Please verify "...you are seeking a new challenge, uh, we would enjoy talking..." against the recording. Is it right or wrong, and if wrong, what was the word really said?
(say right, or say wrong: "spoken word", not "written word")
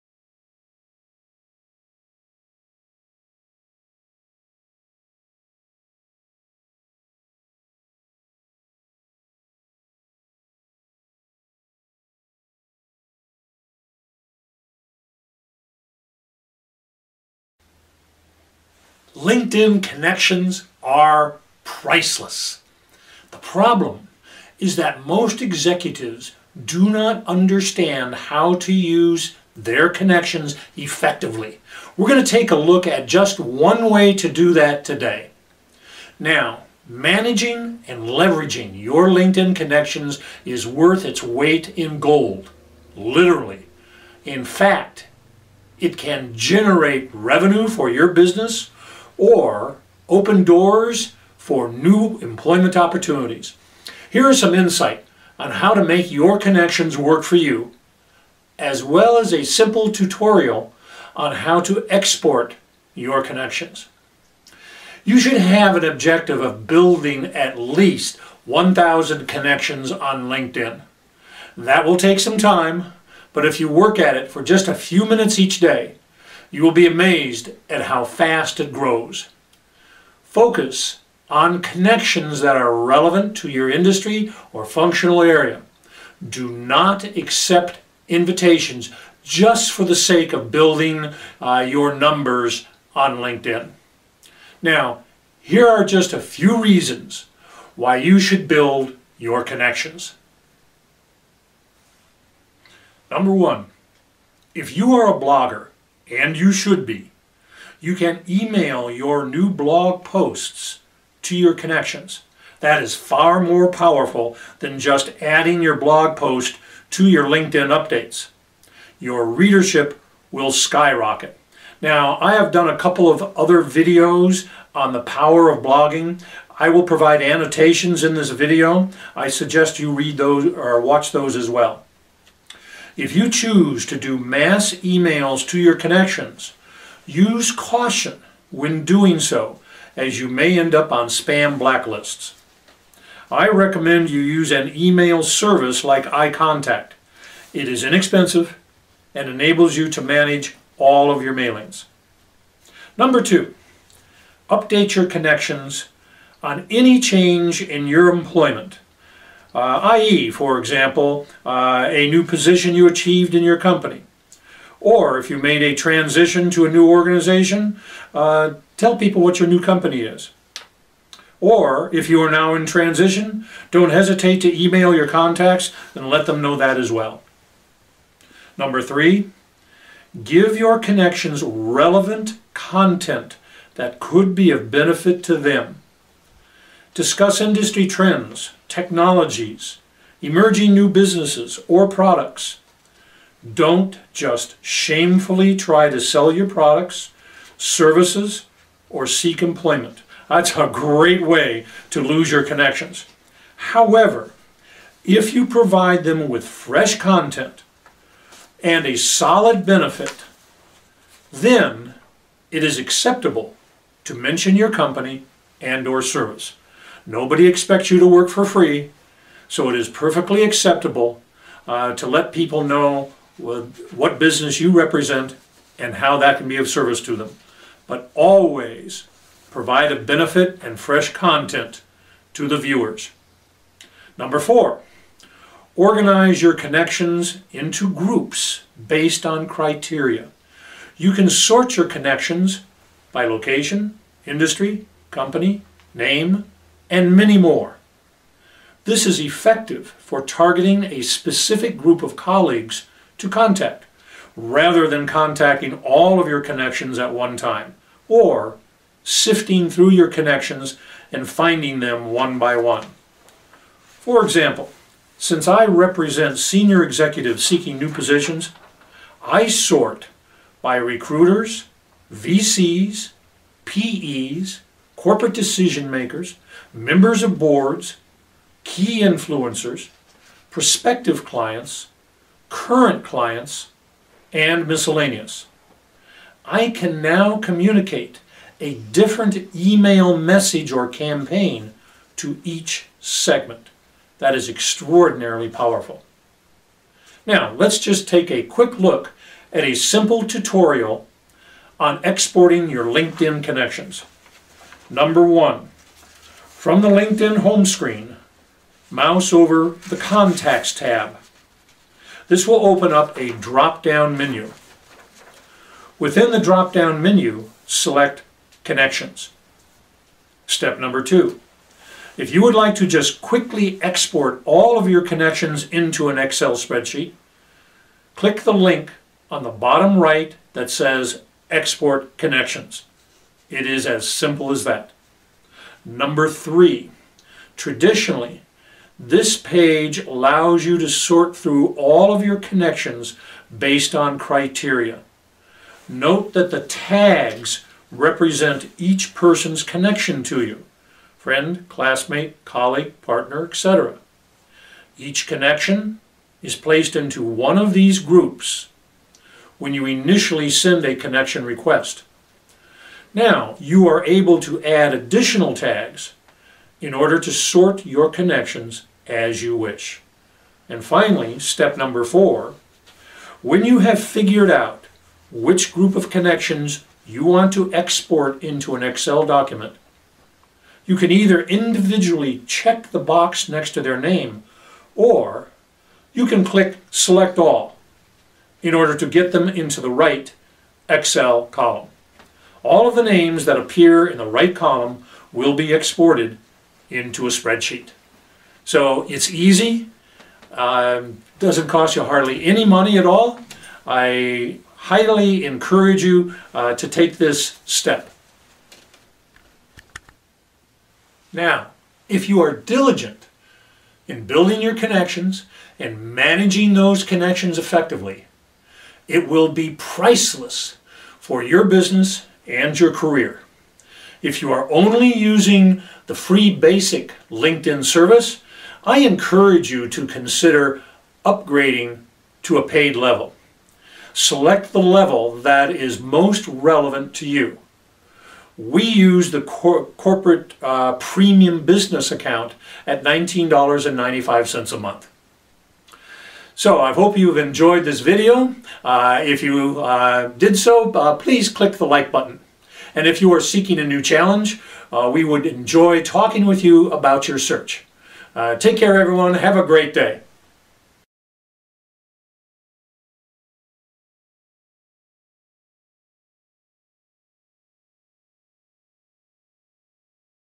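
right.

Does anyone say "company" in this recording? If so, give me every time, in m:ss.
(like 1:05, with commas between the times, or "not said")
2:43, 2:49, 3:34, 4:05.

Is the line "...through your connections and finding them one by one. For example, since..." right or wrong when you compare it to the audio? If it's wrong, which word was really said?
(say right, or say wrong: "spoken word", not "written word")
right.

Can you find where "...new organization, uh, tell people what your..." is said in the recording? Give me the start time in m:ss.
2:46.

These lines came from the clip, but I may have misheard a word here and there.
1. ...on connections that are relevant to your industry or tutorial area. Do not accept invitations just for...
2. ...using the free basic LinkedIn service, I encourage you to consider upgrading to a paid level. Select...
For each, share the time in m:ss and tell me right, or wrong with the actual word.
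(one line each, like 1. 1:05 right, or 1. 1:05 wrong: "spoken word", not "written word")
1. 1:21 wrong: "functional", not "tutorial"
2. 7:05 right.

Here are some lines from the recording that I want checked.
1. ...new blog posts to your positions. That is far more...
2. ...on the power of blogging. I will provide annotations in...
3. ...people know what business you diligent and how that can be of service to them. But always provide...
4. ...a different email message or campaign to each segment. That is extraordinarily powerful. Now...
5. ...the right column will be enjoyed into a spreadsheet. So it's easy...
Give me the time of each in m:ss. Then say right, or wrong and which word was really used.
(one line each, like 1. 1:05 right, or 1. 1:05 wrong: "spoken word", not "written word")
1. 1:49 wrong: "connections", not "positions"
2. 2:04 right
3. 3:42 wrong: "represent", not "diligent"
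4. 4:48 right
5. 6:34 wrong: "exported", not "enjoyed".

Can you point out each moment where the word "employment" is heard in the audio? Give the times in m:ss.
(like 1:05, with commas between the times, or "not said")
0:52, 2:38, 3:19.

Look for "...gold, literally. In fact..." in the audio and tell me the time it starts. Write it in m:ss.
0:41.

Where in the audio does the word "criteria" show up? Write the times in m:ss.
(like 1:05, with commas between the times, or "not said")
3:59, 5:44.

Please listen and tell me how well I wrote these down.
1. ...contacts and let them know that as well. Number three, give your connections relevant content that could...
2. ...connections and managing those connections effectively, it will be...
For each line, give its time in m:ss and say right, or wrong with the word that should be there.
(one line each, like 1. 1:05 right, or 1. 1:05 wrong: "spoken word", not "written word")
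1. 2:55 right
2. 6:54 right.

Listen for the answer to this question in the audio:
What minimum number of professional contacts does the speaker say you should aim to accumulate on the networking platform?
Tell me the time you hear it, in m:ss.
1:08.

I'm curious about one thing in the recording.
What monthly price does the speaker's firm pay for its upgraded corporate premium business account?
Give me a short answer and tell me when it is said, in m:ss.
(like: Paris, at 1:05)
$19.95, at 7:23.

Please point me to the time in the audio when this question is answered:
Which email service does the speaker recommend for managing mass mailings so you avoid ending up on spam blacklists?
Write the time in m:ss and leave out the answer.
2:26.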